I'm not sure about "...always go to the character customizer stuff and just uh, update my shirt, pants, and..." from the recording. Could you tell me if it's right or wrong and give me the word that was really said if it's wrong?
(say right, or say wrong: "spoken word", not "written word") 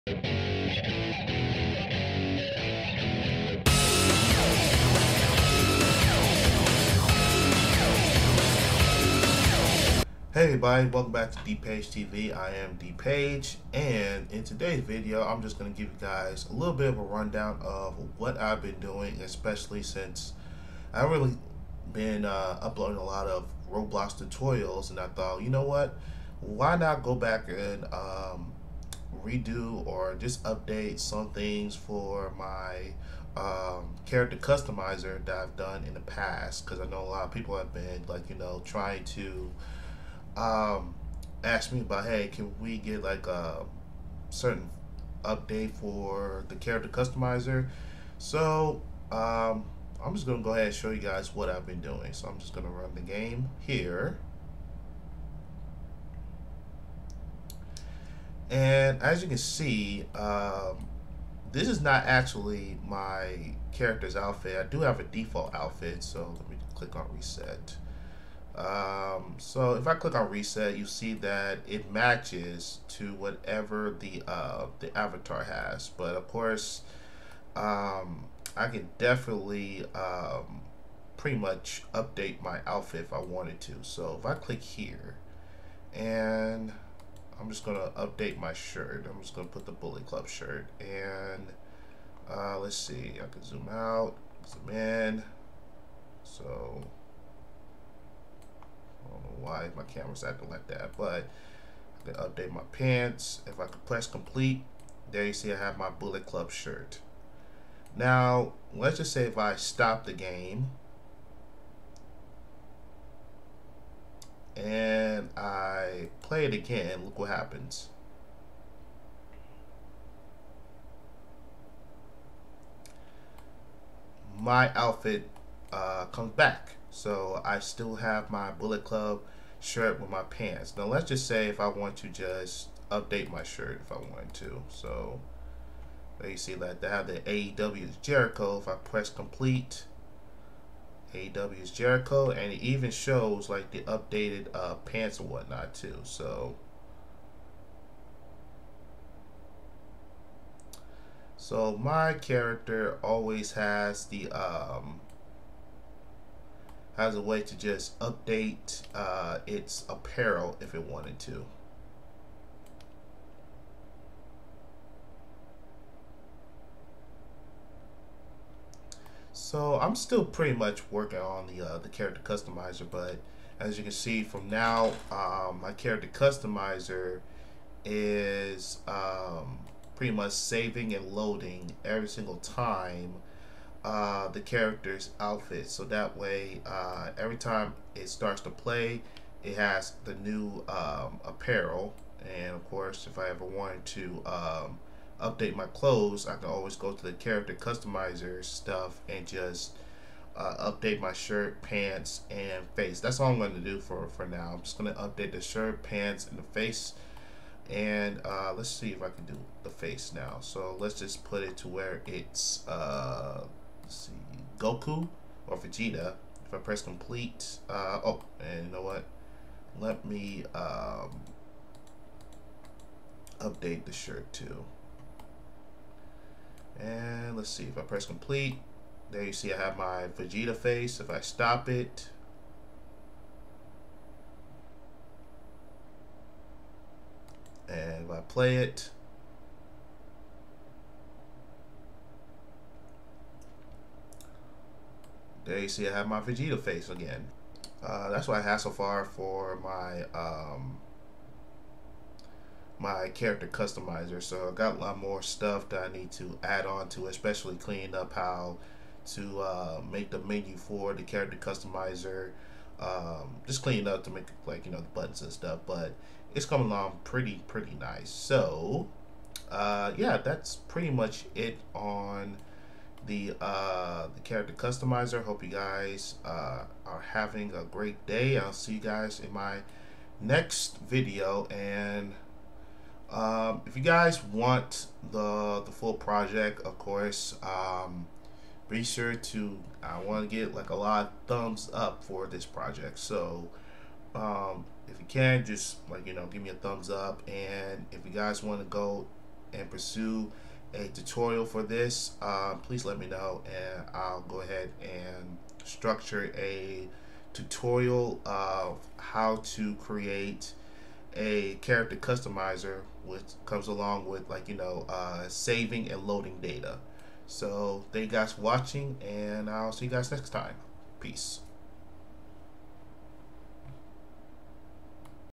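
right.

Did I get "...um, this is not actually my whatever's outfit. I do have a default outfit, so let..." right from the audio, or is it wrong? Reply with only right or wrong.
wrong.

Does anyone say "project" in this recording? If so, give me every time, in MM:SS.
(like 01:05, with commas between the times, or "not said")
04:45, 04:52.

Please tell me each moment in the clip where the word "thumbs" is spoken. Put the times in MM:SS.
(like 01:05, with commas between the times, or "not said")
04:51, 04:56.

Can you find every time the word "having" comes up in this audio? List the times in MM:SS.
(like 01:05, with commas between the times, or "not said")
04:37.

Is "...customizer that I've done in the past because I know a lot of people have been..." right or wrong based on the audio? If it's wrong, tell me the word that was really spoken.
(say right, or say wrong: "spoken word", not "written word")
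right.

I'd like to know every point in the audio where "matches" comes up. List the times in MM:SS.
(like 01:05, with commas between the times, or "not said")
01:11.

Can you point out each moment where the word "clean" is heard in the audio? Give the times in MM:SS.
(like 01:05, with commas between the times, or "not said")
04:17, 04:23.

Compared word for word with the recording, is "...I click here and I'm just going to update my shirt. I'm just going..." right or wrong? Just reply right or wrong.
right.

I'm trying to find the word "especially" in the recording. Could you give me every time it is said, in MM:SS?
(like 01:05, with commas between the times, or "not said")
00:19, 04:17.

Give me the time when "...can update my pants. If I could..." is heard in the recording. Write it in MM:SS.
01:42.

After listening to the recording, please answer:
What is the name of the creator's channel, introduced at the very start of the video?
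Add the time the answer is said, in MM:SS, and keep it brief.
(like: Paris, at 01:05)
Paige TV, at 00:11.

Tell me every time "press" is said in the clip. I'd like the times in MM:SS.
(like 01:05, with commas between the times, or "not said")
01:43, 02:18, 03:36, 03:47.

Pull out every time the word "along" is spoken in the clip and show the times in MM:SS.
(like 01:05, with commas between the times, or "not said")
04:26, 05:13.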